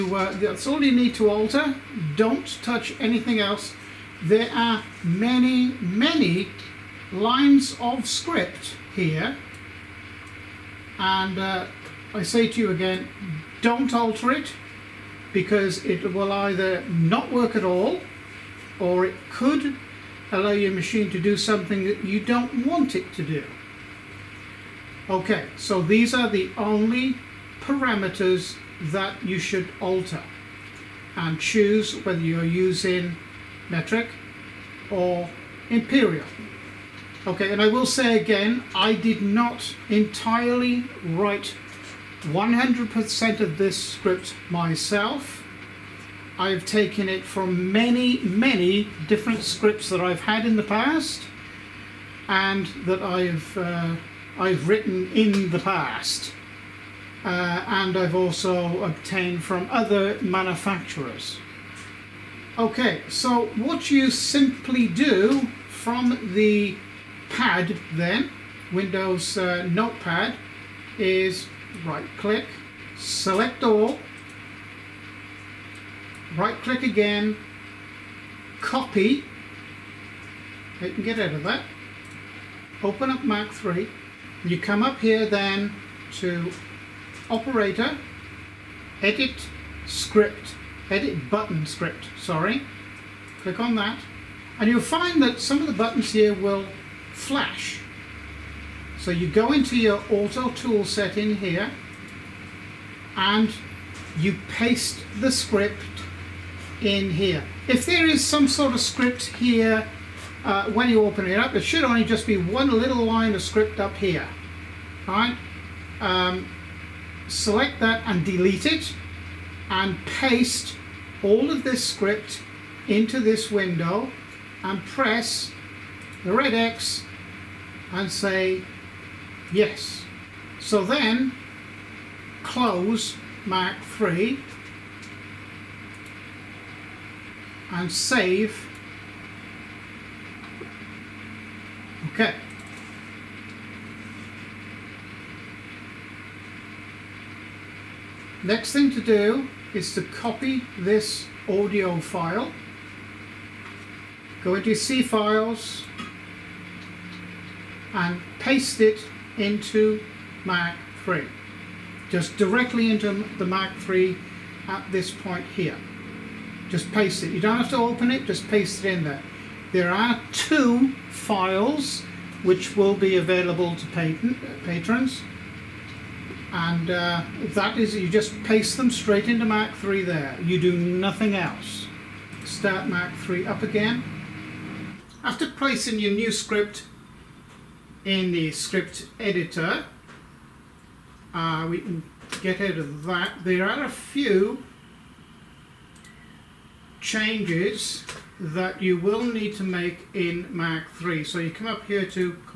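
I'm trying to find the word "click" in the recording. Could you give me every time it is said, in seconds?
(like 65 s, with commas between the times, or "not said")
72 s, 76 s, 93 s.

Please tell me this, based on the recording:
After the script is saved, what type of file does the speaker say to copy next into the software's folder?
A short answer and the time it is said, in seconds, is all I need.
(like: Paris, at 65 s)
audio file, at 151 s.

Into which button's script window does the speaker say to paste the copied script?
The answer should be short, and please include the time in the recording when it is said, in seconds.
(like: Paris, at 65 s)
auto tool set, at 100 s.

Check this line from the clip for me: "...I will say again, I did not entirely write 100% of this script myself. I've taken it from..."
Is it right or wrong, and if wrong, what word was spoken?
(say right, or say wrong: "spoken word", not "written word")
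right.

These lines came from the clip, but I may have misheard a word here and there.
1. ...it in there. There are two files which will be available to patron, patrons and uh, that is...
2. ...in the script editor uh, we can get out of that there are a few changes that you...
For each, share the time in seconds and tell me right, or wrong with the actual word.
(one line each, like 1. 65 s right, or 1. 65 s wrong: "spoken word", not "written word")
1. 168 s right
2. 188 s right.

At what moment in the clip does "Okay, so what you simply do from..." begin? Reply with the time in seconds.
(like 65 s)
62 s.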